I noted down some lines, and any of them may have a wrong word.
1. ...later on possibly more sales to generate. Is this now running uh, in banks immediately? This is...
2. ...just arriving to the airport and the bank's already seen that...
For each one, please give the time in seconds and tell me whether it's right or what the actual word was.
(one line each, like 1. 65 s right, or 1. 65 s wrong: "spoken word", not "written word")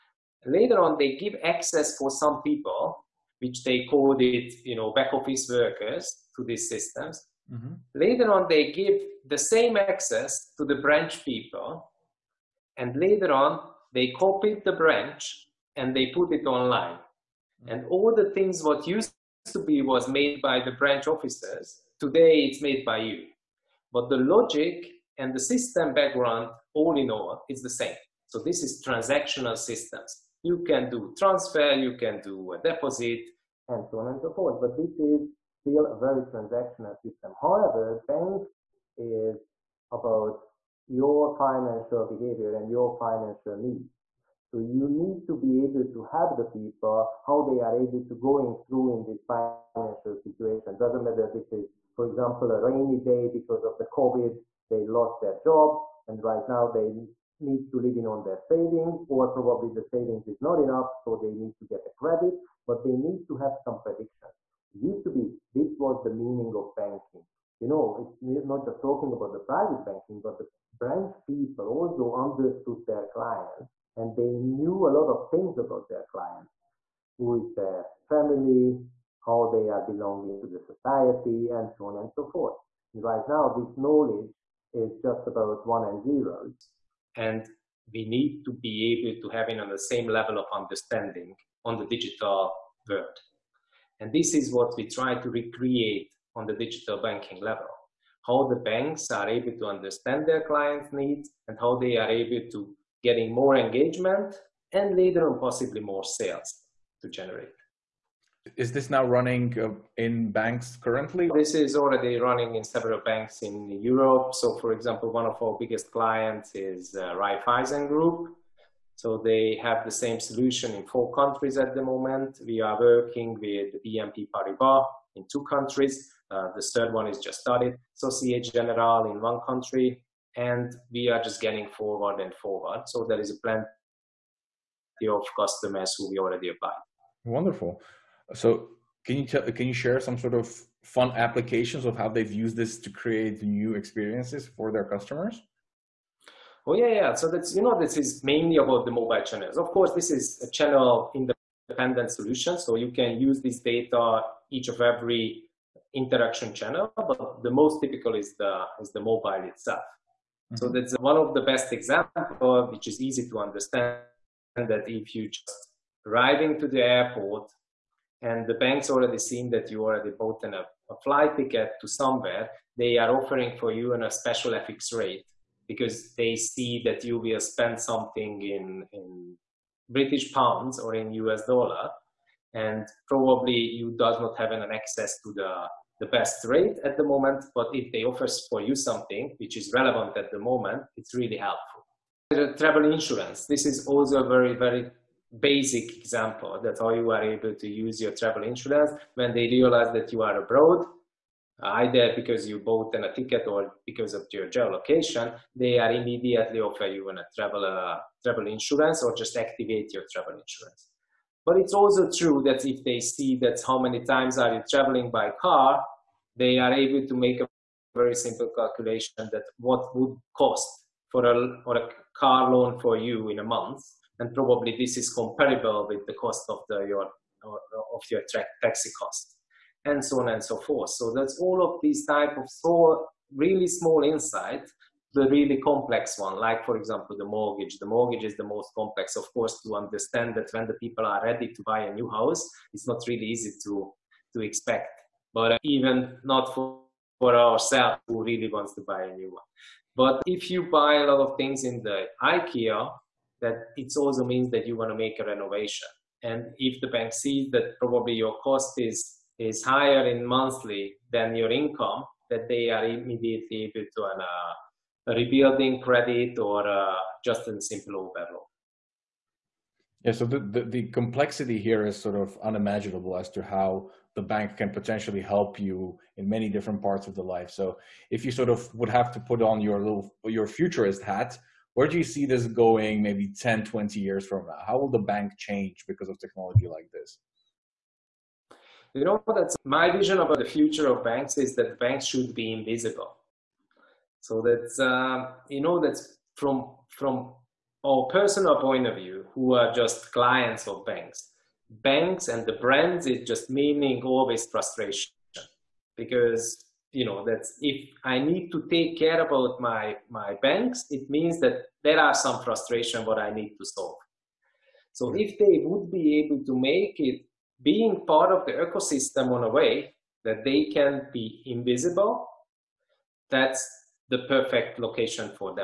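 1. 104 s wrong: "currently", not "immediately"
2. 165 s right.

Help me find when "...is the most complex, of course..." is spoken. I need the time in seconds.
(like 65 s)
238 s.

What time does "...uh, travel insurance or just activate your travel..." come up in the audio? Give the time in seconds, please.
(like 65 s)
207 s.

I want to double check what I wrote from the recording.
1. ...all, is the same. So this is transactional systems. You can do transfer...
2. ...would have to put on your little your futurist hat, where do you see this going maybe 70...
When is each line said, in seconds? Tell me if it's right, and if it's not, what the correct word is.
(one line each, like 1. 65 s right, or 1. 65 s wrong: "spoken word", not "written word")
1. 27 s right
2. 278 s wrong: "10", not "70".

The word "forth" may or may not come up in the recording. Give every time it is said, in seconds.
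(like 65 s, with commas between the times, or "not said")
34 s, 82 s, 230 s.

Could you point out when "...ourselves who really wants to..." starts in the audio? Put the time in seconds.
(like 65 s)
247 s.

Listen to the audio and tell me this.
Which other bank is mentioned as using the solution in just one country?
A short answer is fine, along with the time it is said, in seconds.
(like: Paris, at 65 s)
Societe Generale, at 127 s.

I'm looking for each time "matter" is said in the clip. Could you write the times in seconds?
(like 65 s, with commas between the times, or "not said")
51 s.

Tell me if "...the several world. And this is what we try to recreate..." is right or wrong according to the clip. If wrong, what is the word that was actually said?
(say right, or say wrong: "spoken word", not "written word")
wrong: "digital", not "several".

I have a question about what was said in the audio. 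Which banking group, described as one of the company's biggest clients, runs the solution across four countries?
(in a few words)
Raiffeisen Group.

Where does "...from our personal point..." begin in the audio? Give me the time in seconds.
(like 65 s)
296 s.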